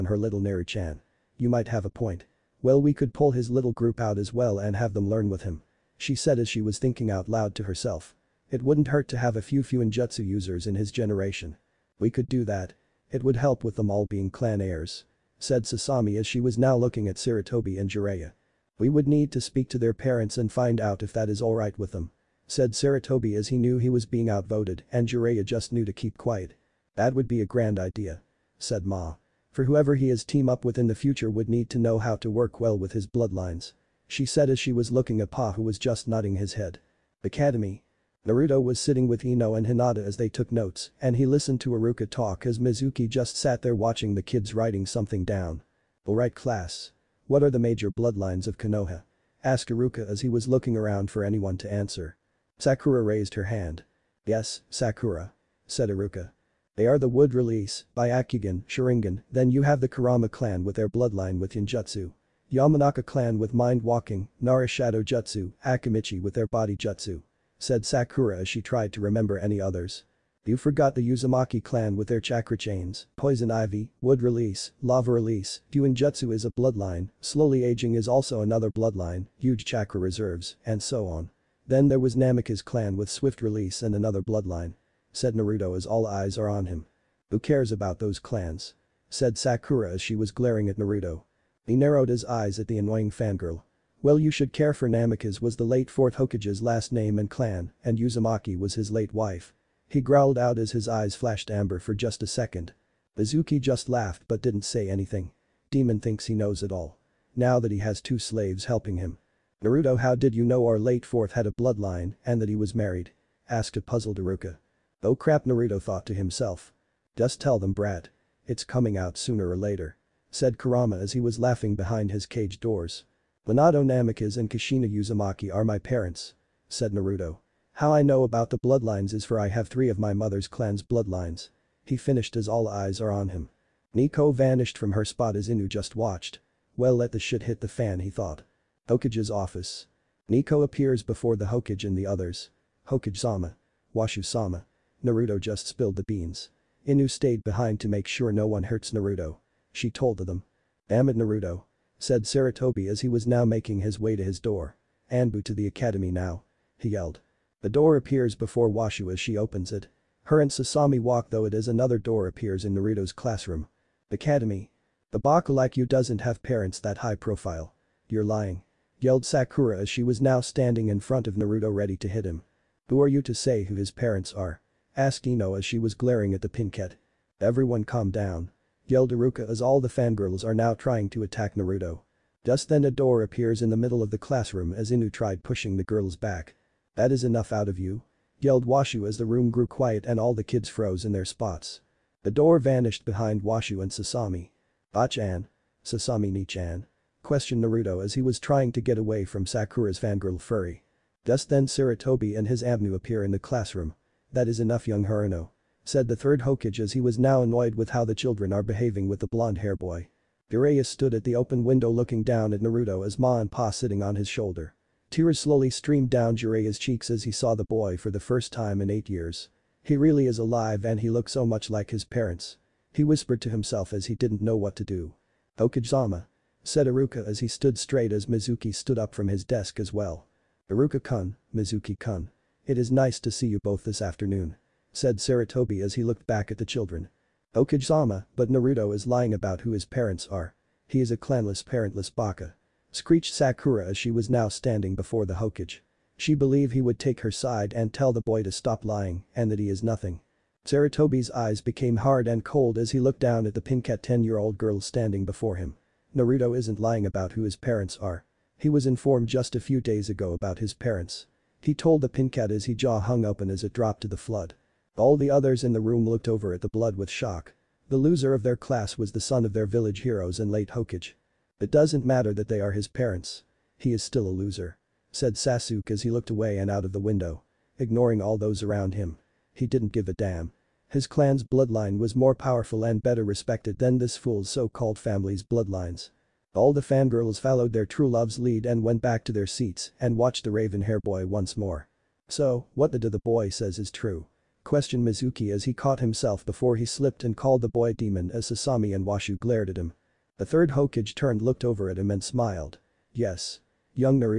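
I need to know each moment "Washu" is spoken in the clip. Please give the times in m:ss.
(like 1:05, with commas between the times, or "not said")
2:23, 2:38, 3:08, 3:13, 4:59.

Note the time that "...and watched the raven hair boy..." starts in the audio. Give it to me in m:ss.
4:50.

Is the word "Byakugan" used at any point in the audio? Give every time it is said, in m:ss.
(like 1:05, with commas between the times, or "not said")
0:57.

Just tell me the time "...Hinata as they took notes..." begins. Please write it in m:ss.
0:39.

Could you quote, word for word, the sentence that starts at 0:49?
Asked Iruka as he was looking around for anyone to answer.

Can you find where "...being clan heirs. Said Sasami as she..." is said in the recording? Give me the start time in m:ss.
0:14.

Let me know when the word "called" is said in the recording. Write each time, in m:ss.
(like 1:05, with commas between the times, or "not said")
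4:44, 4:57.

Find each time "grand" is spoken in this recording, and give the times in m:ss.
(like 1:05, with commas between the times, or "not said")
0:27.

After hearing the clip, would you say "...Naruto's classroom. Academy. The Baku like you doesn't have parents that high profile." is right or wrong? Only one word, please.
right.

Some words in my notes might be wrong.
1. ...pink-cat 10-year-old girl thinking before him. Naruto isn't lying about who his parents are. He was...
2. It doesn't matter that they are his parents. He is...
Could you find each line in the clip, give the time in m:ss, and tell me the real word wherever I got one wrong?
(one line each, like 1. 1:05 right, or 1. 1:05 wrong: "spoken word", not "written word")
1. 4:13 wrong: "standing", not "thinking"
2. 4:31 right.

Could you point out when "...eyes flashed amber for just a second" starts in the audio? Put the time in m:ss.
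1:40.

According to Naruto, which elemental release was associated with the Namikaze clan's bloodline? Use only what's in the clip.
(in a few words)
Swift release.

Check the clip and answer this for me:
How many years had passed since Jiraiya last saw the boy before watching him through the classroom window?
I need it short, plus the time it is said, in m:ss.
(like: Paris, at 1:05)
8, at 3:38.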